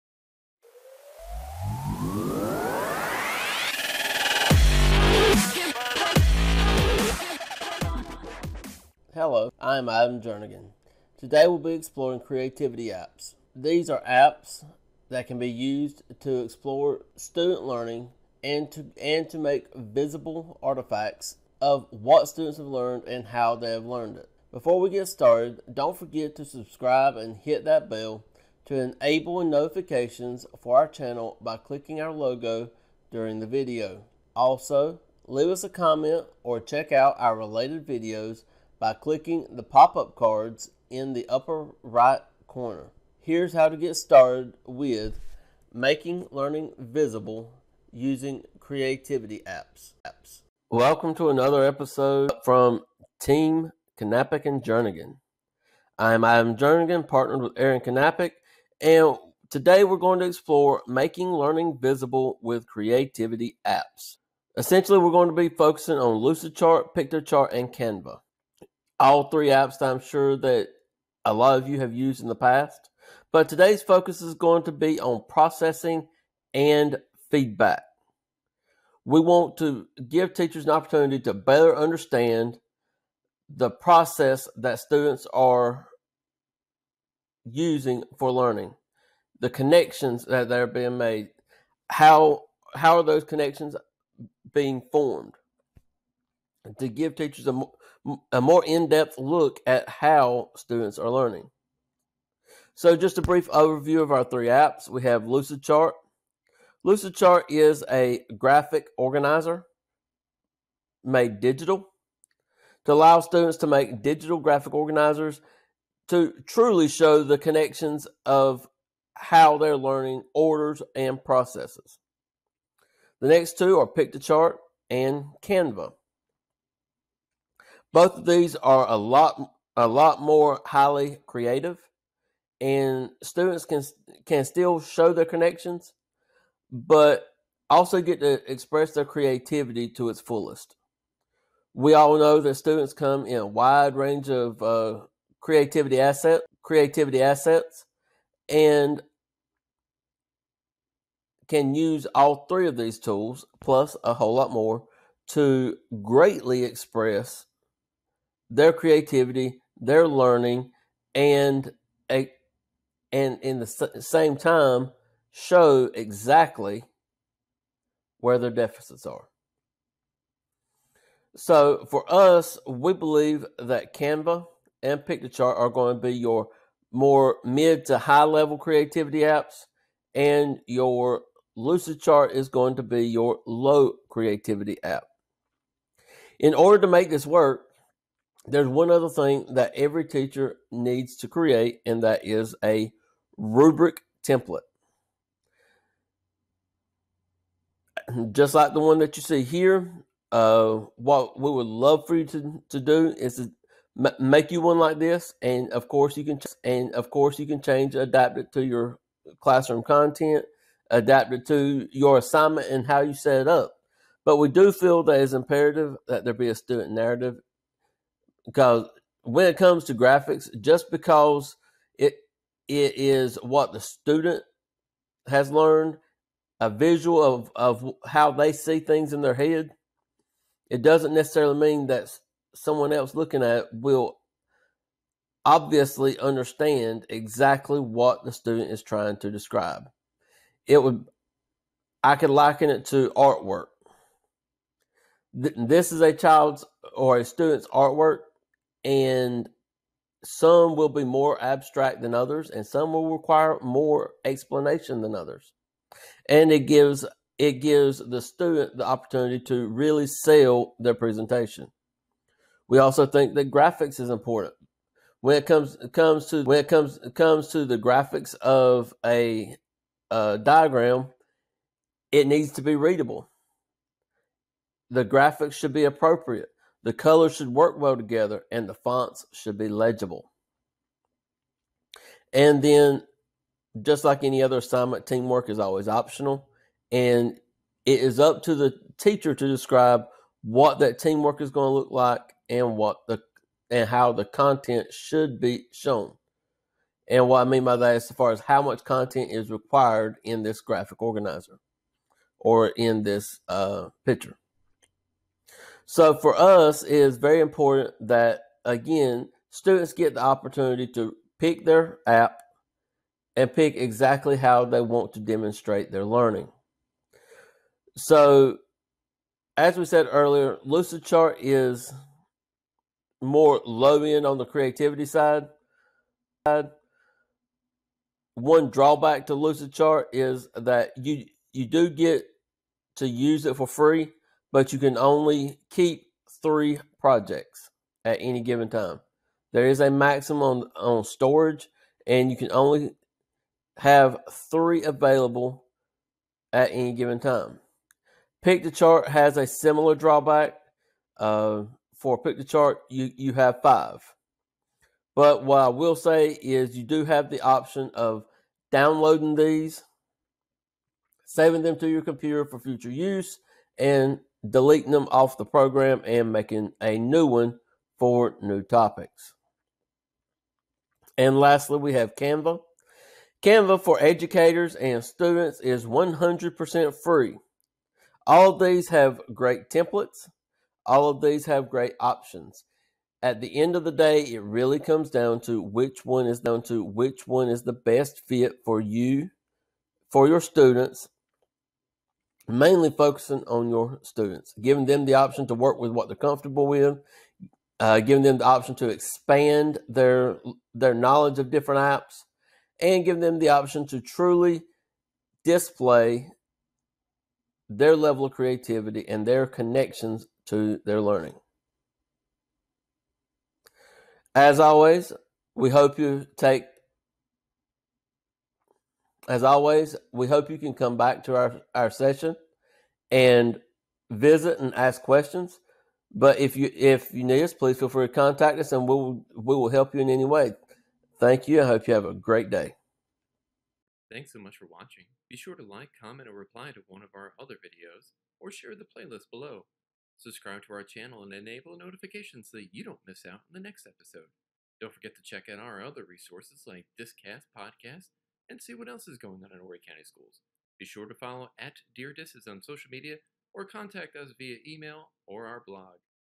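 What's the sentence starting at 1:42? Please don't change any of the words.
So just a brief overview of our three apps.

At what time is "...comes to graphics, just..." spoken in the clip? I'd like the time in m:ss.
3:39.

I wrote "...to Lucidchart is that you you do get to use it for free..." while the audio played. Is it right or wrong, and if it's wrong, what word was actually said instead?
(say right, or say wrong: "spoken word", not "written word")
right.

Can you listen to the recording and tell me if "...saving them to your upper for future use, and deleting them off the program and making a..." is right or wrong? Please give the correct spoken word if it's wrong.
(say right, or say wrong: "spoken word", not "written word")
wrong: "computer", not "upper".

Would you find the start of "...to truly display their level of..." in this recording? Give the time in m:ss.
6:43.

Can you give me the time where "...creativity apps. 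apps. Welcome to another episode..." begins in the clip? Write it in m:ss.
0:48.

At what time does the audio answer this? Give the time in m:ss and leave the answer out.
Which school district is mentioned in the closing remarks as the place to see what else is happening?
7:29.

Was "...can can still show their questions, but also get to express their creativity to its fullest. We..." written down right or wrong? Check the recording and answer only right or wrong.
wrong.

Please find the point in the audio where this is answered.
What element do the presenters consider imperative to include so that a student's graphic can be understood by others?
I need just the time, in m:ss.
3:36.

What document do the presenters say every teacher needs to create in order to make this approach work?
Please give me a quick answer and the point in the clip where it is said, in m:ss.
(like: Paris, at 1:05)
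rubric template, at 3:13.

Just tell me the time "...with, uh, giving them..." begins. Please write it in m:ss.
6:36.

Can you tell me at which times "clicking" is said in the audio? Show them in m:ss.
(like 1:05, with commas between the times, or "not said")
0:31, 0:38.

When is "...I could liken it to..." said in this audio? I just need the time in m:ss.
4:02.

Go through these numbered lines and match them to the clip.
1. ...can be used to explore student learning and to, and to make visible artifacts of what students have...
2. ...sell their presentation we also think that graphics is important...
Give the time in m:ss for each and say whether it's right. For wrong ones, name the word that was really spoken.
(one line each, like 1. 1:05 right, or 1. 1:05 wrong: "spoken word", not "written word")
1. 0:15 right
2. 4:20 right.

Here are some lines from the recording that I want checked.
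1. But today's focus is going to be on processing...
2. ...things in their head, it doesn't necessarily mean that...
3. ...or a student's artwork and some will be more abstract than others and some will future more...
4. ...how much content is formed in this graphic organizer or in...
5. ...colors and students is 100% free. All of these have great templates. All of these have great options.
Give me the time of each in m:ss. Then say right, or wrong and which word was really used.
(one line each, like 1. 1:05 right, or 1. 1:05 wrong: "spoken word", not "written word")
1. 1:13 right
2. 3:48 right
3. 4:06 wrong: "require", not "future"
4. 4:58 wrong: "required", not "formed"
5. 6:14 wrong: "educators", not "colors".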